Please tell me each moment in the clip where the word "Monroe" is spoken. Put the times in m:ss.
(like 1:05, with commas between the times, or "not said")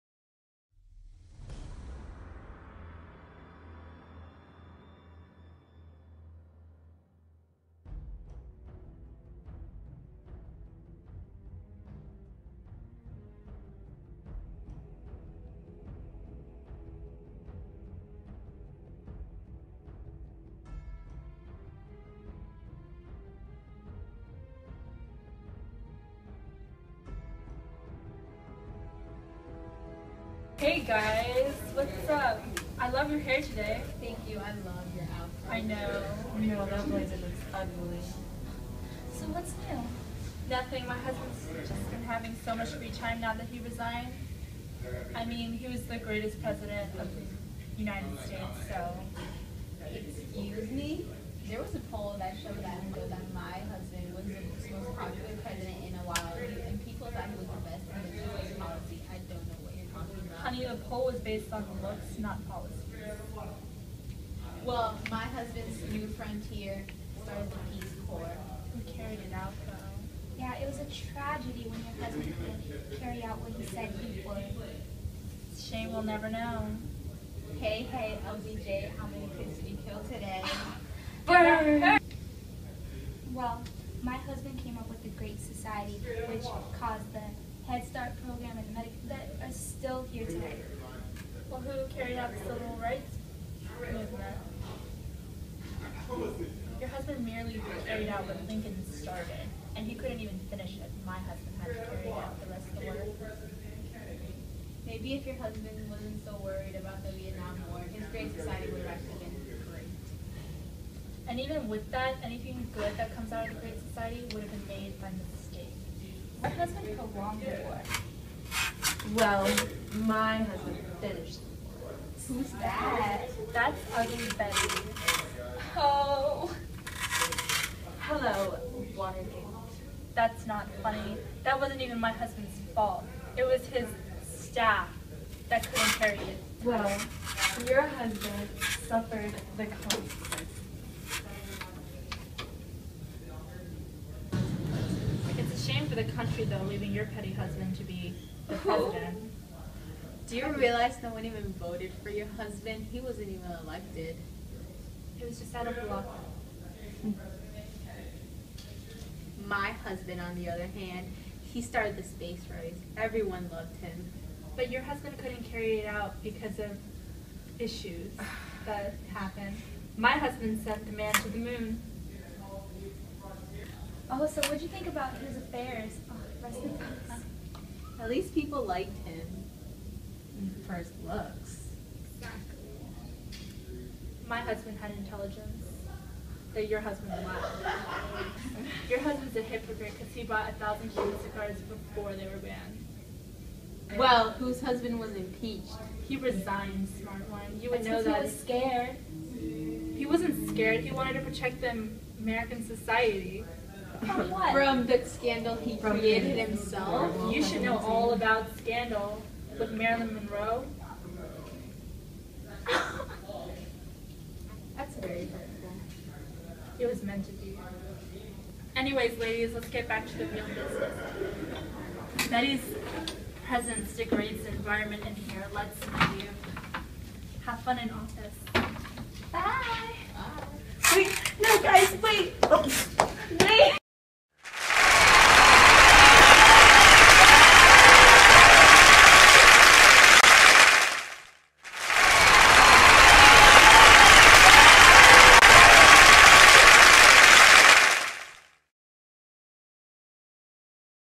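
3:30.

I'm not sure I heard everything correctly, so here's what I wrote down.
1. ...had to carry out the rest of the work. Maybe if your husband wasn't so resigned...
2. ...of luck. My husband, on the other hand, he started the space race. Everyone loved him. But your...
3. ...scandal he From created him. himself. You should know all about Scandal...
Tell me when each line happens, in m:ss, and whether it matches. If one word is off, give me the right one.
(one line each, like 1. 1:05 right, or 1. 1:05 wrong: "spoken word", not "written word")
1. 1:41 wrong: "worried", not "resigned"
2. 2:35 right
3. 3:25 right.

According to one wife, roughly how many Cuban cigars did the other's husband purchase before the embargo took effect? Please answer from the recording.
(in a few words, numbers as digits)
1,000.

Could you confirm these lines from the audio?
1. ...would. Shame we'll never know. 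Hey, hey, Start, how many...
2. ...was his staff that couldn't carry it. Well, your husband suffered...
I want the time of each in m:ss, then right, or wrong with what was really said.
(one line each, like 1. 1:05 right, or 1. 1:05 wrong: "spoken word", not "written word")
1. 1:14 wrong: "LBJ", not "Start"
2. 2:13 right.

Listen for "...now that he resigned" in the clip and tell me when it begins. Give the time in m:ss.
0:43.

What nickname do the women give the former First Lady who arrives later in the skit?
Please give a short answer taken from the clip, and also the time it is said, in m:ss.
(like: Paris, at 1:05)
Ugly Betty, at 2:03.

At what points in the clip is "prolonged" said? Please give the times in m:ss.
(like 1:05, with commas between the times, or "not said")
1:56.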